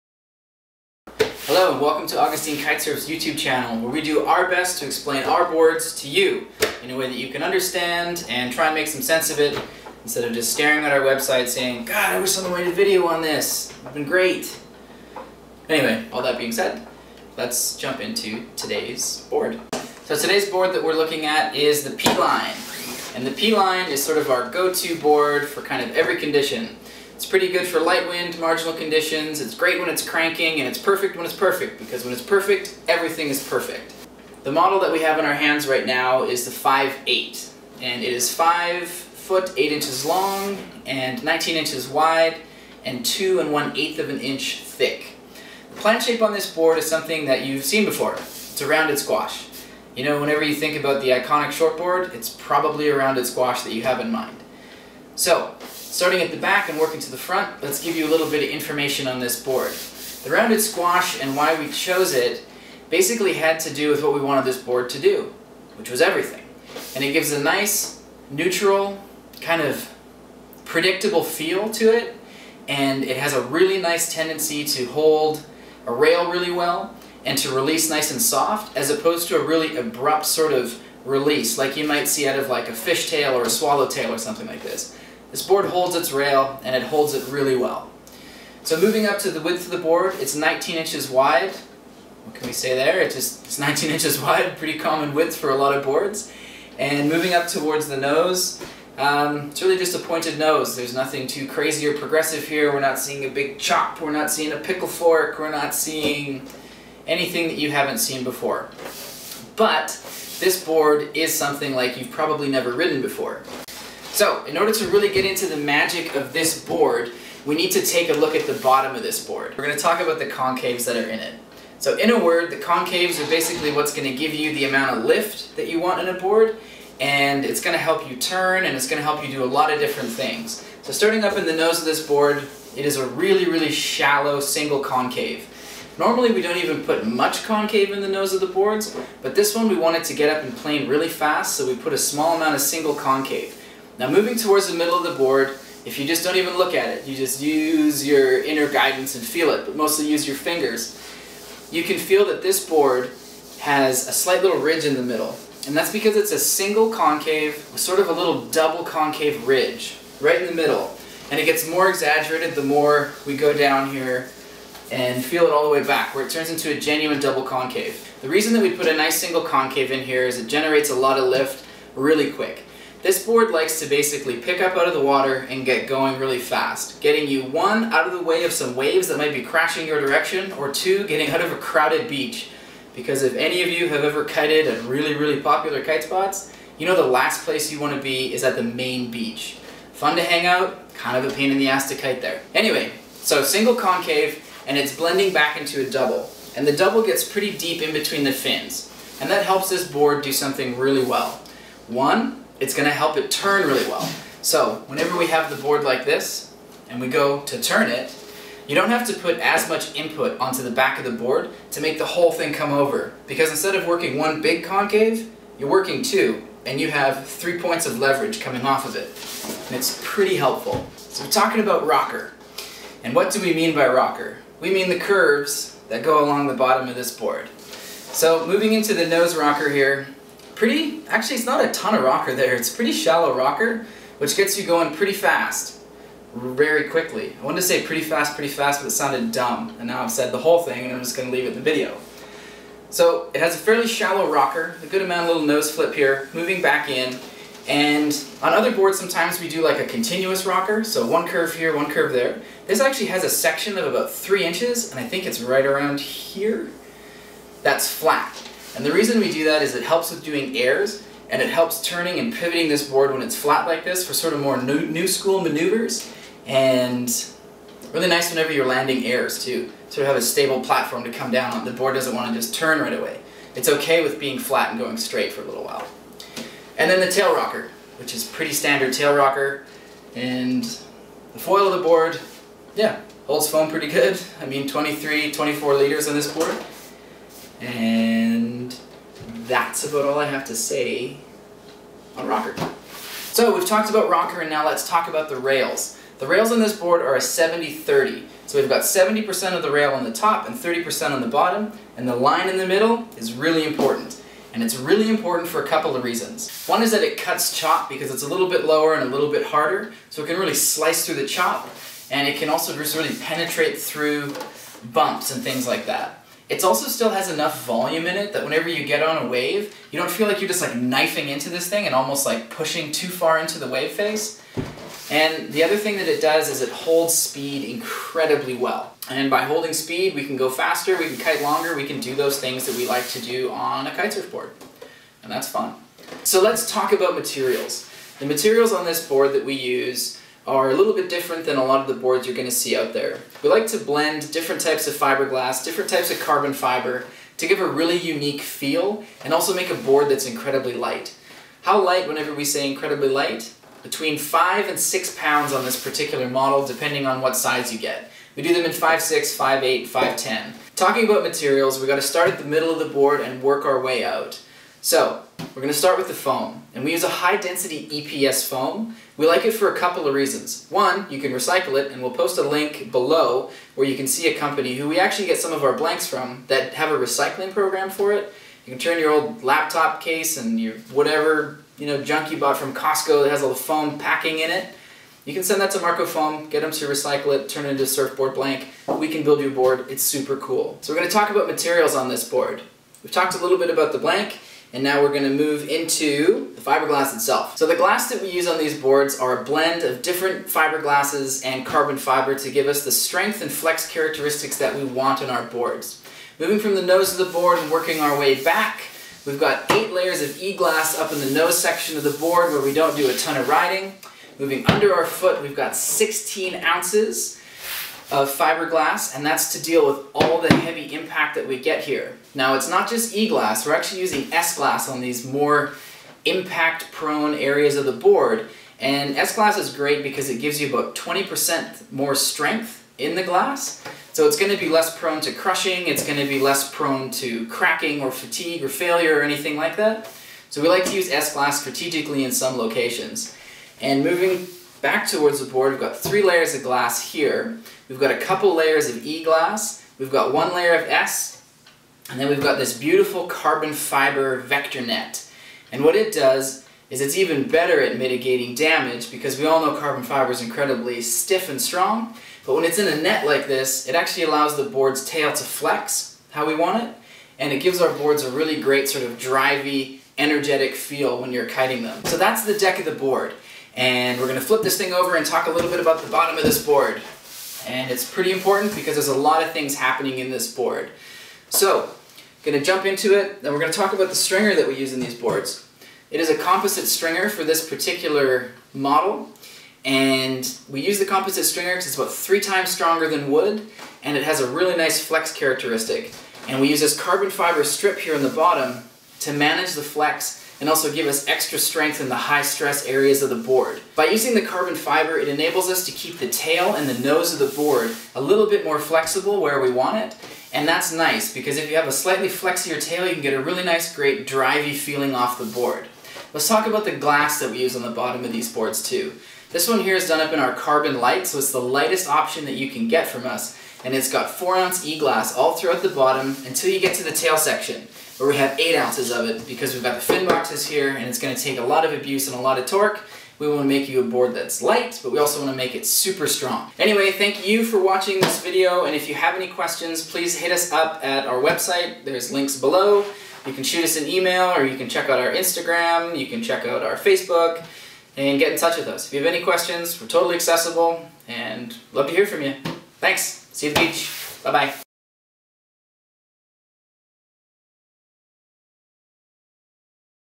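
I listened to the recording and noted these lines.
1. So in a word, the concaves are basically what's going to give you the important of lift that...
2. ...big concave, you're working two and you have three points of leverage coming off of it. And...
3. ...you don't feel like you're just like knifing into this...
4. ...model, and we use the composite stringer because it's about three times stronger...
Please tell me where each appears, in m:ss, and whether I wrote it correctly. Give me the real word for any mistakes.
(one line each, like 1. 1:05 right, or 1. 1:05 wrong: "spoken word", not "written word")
1. 2:01 wrong: "amount", not "important"
2. 3:34 right
3. 5:19 right
4. 8:08 right.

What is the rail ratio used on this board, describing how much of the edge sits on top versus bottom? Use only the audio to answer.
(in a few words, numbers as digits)
70-30.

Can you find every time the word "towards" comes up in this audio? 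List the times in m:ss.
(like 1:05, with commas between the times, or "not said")
1:37, 2:24, 7:25.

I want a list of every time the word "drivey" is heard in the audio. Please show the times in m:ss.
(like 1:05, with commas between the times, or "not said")
7:49, 8:34.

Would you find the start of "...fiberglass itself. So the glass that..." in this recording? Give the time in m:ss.
6:36.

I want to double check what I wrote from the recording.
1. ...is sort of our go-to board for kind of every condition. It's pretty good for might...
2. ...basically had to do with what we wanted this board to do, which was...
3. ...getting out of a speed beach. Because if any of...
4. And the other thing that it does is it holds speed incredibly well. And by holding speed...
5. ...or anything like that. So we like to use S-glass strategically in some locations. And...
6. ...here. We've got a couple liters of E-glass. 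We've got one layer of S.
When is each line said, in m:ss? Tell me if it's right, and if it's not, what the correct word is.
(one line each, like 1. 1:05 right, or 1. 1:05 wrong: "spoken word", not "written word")
1. 0:23 wrong: "light", not "might"
2. 1:02 right
3. 3:01 wrong: "crowded", not "speed"
4. 5:25 right
5. 7:19 right
6. 7:27 wrong: "layers", not "liters".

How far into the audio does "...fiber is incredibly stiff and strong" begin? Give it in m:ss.
7:40.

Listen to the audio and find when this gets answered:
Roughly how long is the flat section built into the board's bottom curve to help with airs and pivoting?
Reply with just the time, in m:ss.
4:14.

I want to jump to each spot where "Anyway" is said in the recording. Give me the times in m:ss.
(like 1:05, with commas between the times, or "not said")
0:15, 3:12, 8:56.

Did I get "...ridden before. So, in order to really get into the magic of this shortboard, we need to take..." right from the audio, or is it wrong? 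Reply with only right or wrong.
wrong.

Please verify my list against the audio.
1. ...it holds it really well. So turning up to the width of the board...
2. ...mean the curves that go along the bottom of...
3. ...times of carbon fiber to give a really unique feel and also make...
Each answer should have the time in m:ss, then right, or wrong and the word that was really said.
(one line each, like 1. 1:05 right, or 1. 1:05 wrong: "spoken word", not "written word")
1. 1:26 wrong: "moving", not "turning"
2. 3:44 right
3. 5:45 wrong: "types", not "times".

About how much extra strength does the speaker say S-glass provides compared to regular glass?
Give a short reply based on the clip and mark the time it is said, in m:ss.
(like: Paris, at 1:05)
20%, at 7:10.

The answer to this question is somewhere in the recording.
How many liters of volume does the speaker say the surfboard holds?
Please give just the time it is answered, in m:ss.
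4:44.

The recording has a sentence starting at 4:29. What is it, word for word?
Sort of have a stable platform to come down on.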